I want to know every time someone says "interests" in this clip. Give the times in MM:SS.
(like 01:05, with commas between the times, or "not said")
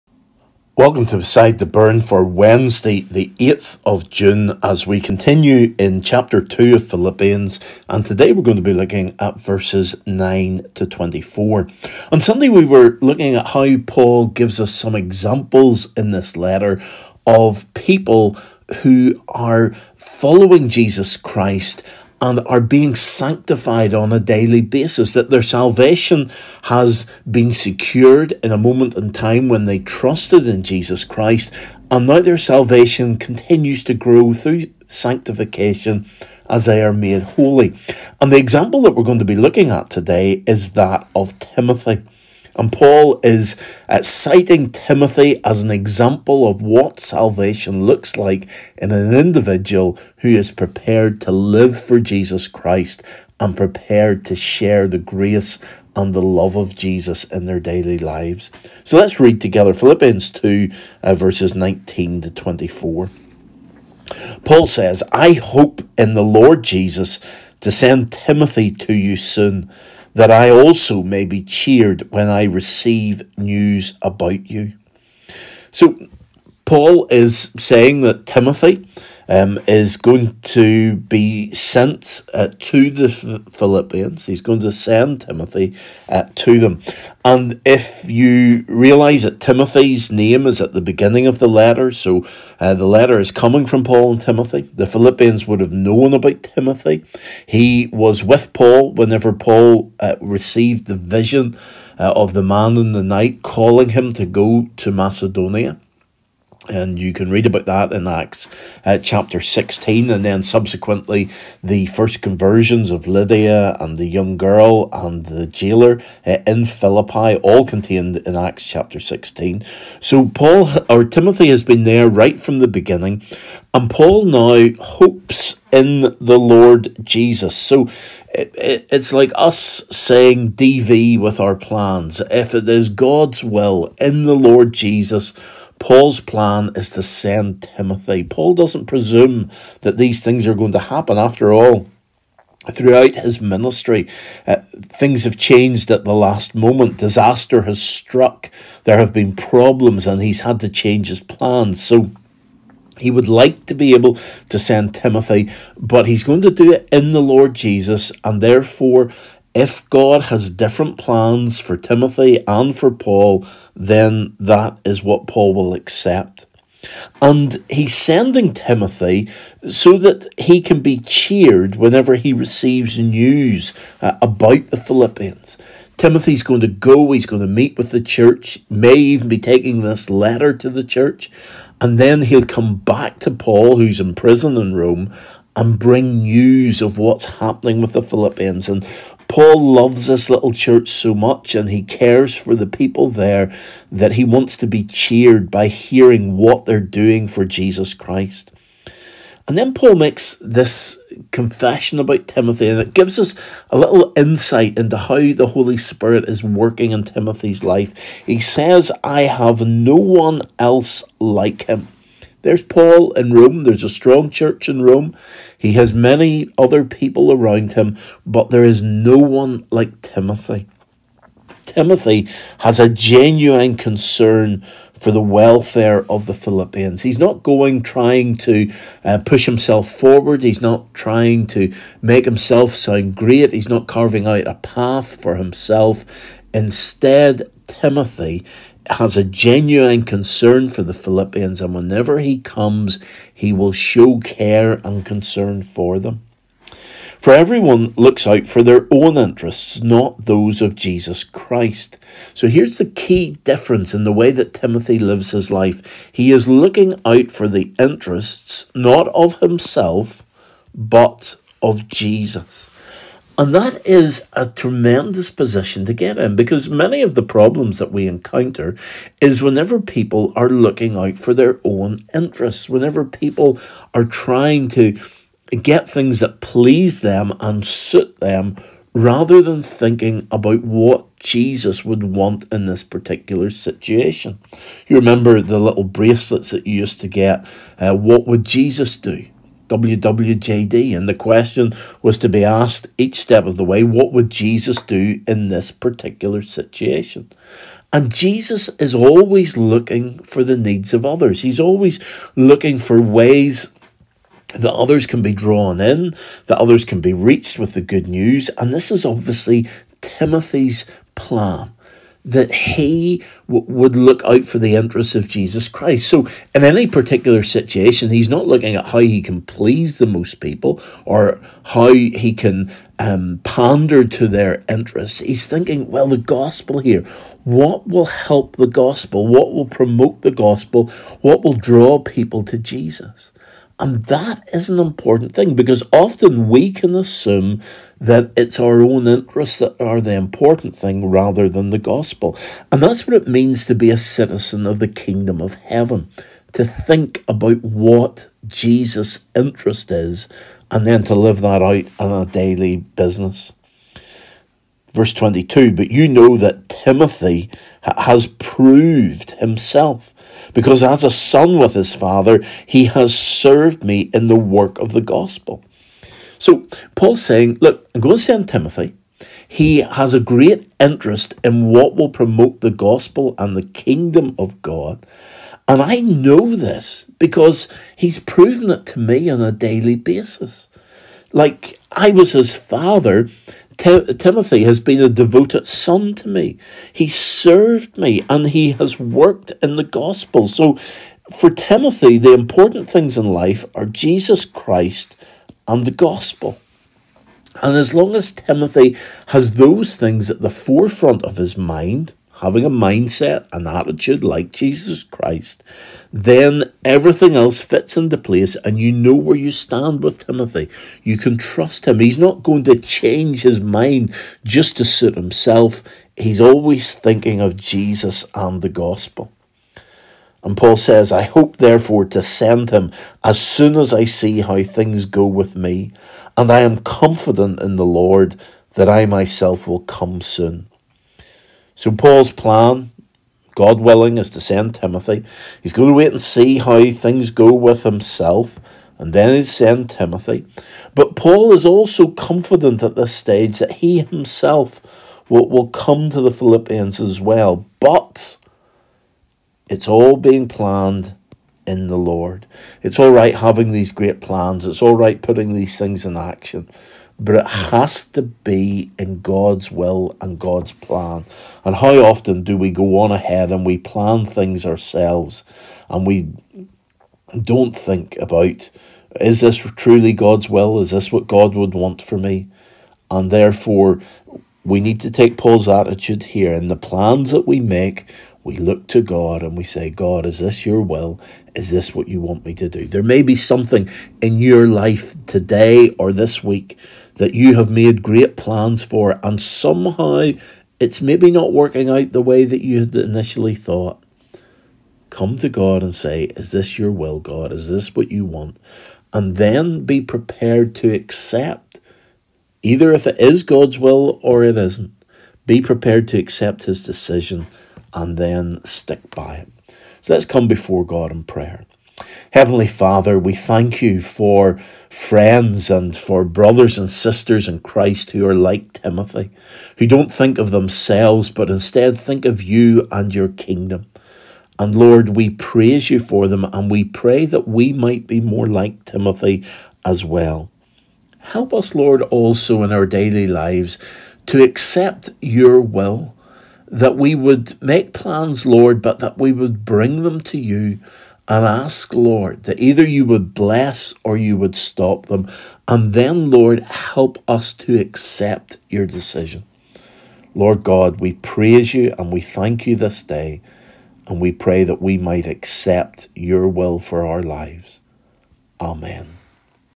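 04:09, 04:17, 04:32, 05:14, 05:24, 05:39, 05:49, 06:10.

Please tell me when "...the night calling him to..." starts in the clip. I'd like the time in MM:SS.
01:42.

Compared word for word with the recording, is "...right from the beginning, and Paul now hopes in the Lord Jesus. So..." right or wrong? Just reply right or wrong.
right.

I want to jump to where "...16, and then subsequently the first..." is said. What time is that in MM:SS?
01:49.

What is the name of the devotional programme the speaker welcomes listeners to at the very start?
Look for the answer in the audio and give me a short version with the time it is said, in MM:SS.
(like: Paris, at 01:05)
Beside the Burn, at 00:01.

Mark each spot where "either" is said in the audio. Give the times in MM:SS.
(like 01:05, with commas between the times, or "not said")
08:22, 09:02.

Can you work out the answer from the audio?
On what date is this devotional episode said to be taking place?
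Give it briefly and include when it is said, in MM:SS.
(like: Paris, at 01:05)
Wednesday, 8 June, at 00:02.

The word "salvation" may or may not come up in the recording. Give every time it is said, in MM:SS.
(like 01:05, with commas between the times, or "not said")
00:25, 00:32, 00:46.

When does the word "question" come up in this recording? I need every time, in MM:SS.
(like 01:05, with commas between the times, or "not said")
04:51.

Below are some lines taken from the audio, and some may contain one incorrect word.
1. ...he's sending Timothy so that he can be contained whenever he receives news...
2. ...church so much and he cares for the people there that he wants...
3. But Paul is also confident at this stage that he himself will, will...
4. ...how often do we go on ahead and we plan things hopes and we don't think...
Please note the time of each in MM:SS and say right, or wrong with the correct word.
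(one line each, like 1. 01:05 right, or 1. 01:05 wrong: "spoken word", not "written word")
1. 02:47 wrong: "cheered", not "contained"
2. 03:10 right
3. 07:20 right
4. 07:41 wrong: "ourselves", not "hopes".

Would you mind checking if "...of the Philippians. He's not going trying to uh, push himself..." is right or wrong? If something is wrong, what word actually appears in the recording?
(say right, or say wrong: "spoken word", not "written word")
right.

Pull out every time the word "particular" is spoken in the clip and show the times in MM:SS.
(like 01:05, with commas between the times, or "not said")
04:42, 04:55, 05:16.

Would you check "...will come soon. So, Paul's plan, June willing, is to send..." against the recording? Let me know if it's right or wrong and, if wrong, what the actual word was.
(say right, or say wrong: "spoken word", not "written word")
wrong: "God", not "June".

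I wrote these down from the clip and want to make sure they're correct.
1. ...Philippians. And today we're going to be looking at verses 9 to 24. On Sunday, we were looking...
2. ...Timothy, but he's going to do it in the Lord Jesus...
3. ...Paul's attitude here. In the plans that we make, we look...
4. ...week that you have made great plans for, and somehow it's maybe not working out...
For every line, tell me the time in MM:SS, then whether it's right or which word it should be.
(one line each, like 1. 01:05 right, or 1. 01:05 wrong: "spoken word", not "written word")
1. 00:06 right
2. 02:34 right
3. 07:55 right
4. 08:06 right.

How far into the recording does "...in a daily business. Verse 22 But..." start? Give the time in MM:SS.
05:51.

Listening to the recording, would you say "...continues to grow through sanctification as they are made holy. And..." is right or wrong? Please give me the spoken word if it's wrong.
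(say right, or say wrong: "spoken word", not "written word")
right.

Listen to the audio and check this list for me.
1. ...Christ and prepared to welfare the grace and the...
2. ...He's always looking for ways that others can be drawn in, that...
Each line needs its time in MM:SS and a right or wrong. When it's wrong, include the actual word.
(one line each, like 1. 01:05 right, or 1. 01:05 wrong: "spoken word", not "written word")
1. 00:52 wrong: "share", not "welfare"
2. 05:01 right.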